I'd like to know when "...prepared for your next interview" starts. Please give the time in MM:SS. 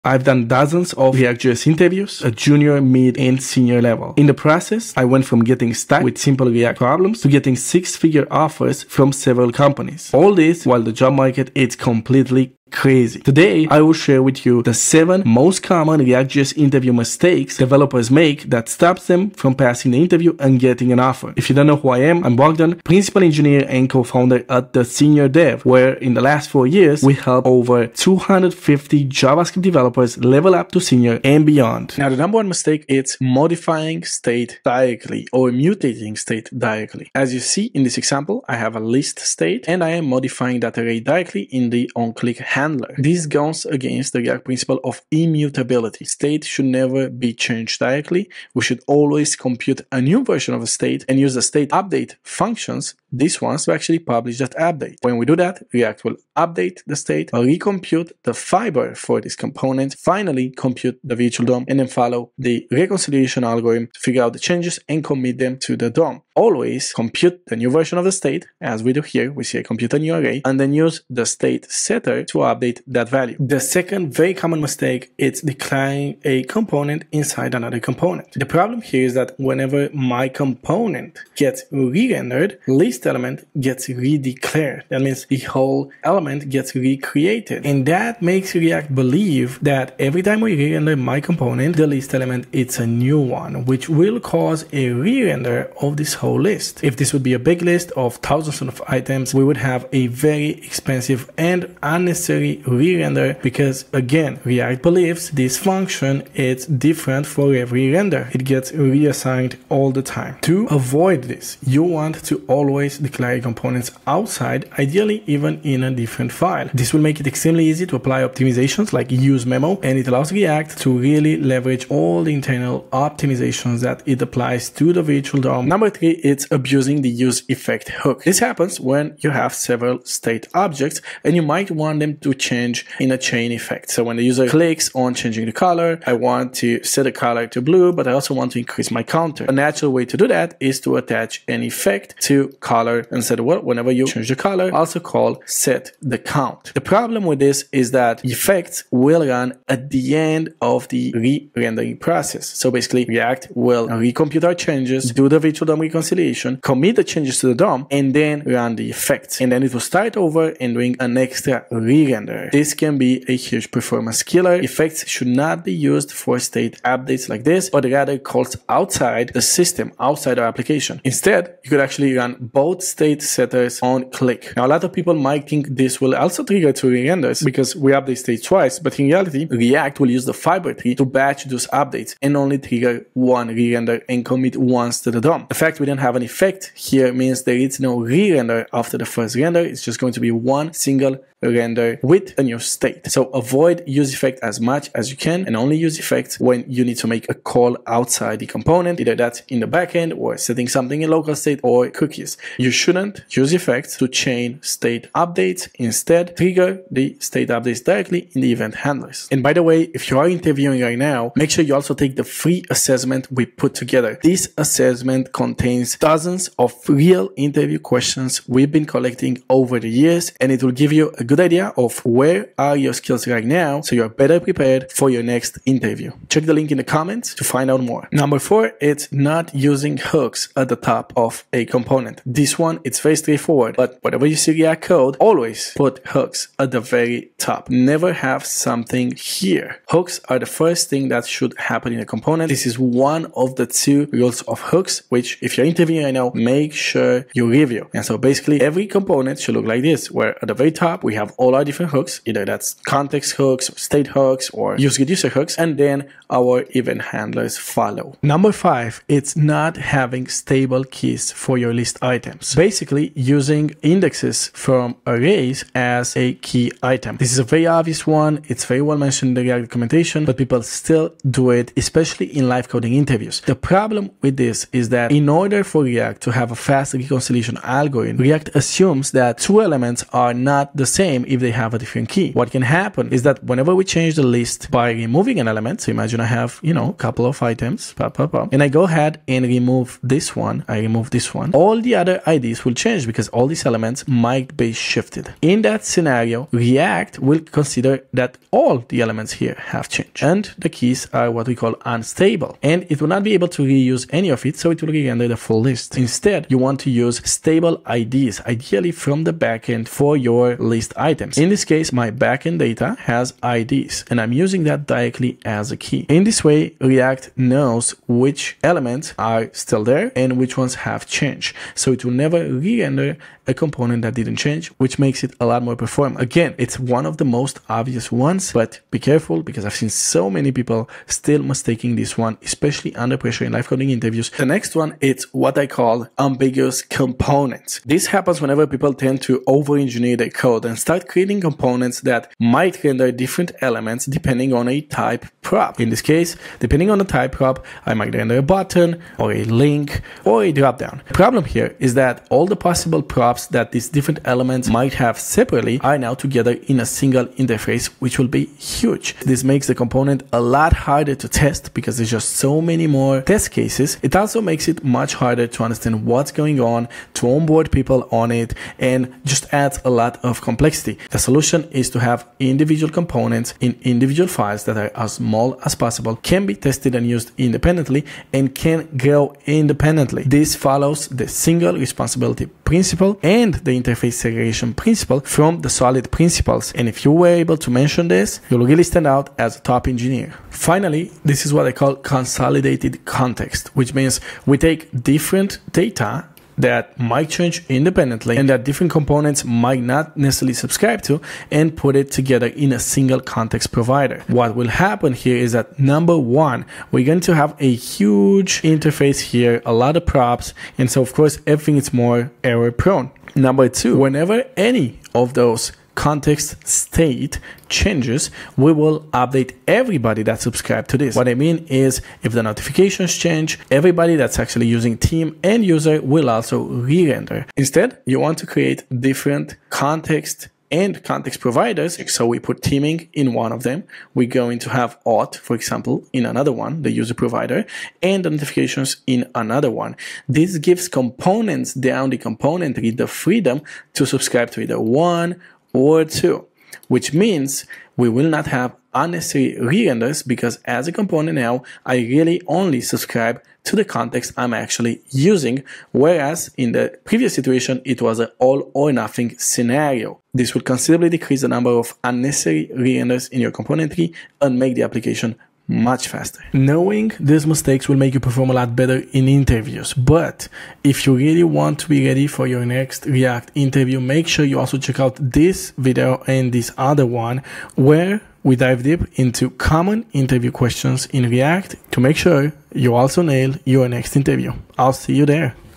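03:44.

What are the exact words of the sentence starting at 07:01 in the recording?
What I mean is if the notifications change, everybody that's actually using team and user will also re-render.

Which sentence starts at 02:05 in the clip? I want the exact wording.
Number three, it's abusing the use effect hook.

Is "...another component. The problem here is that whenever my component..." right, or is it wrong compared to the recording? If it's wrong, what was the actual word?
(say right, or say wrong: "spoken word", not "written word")
right.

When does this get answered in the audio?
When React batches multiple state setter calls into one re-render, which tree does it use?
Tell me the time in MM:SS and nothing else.
03:00.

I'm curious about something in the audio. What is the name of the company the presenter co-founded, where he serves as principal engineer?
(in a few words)
The Senior Dev.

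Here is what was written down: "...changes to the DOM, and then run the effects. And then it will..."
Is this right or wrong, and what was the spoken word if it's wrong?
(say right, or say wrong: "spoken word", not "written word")
right.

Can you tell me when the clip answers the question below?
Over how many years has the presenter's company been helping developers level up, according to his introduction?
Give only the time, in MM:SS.
00:26.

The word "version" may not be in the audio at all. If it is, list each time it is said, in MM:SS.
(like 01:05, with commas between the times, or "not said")
00:50, 01:07.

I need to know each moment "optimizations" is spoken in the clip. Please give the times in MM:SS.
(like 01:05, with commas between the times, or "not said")
01:58, 02:02.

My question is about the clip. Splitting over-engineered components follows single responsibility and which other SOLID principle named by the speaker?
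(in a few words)
interface segregation principle.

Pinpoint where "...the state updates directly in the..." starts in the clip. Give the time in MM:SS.
03:26.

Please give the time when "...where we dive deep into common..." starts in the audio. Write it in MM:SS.
07:57.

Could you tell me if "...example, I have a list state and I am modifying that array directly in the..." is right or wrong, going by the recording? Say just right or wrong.
right.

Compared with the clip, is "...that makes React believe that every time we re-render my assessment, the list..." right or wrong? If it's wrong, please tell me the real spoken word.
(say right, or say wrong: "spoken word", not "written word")
wrong: "component", not "assessment".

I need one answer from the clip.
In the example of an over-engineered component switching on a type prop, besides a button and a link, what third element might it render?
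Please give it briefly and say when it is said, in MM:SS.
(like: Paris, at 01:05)
dropdown, at 05:50.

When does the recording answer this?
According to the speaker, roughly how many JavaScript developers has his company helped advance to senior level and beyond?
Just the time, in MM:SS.
00:27.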